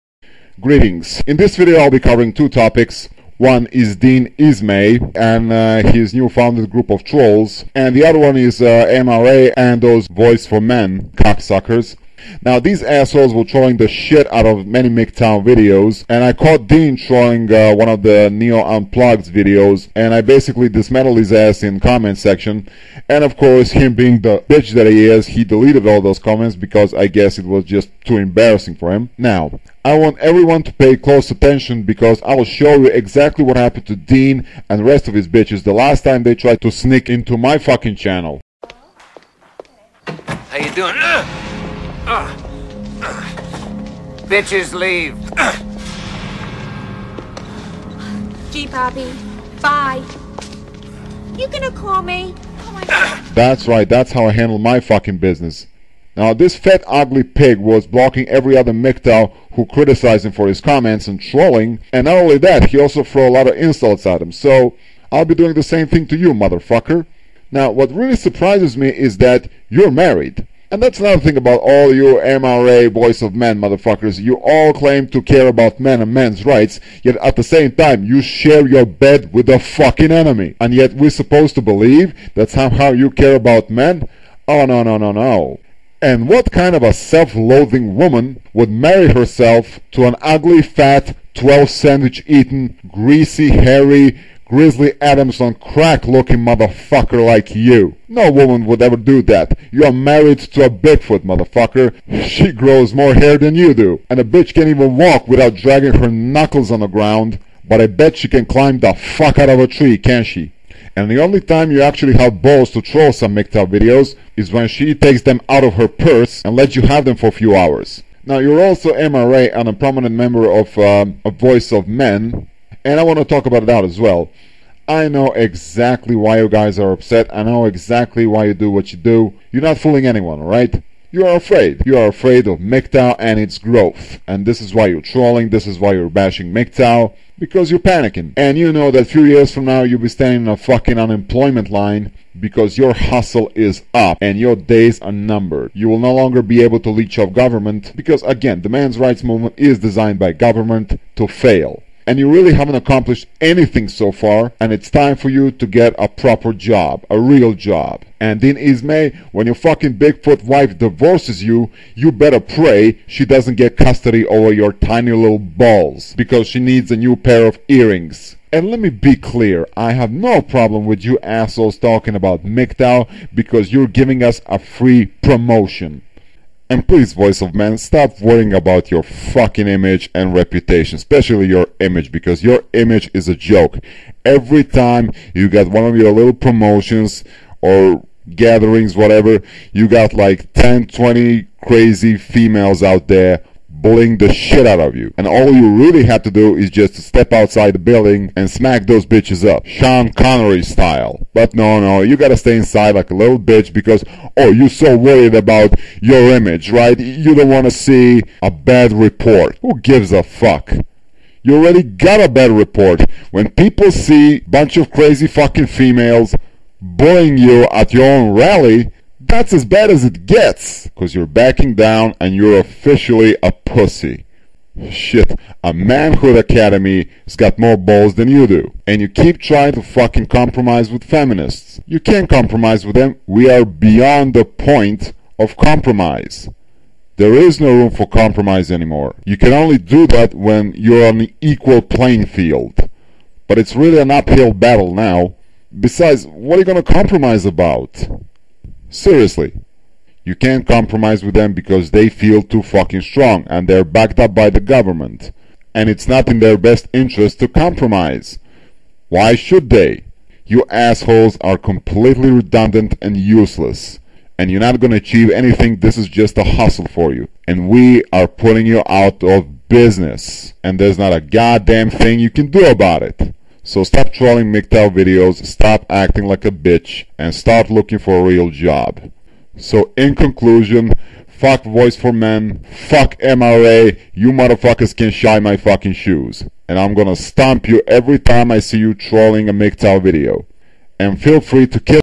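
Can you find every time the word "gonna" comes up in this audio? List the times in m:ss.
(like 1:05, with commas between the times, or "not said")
0:51, 4:46.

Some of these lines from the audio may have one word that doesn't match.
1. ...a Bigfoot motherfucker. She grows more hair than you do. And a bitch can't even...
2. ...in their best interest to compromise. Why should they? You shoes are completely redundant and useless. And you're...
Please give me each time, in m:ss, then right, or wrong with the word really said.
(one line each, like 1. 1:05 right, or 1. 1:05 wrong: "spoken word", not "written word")
1. 1:40 right
2. 4:16 wrong: "assholes", not "shoes".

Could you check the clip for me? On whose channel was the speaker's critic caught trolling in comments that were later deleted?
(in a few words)
Neo Unplugged.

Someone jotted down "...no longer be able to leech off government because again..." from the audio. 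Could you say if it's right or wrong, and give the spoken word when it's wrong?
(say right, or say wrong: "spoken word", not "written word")
right.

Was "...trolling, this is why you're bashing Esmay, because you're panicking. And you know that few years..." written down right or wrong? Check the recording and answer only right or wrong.
wrong.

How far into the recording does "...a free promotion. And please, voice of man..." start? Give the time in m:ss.
2:54.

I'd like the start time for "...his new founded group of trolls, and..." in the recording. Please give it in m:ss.
0:05.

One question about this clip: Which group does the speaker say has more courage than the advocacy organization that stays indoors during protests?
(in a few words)
Manhood Academy.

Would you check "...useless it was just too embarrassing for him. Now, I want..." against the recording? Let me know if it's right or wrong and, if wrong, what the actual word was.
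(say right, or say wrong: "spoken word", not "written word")
wrong: "guess", not "useless".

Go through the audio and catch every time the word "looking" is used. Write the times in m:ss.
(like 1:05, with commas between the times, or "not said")
1:36, 4:37.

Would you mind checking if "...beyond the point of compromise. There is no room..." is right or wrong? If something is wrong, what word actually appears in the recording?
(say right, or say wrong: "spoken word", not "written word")
right.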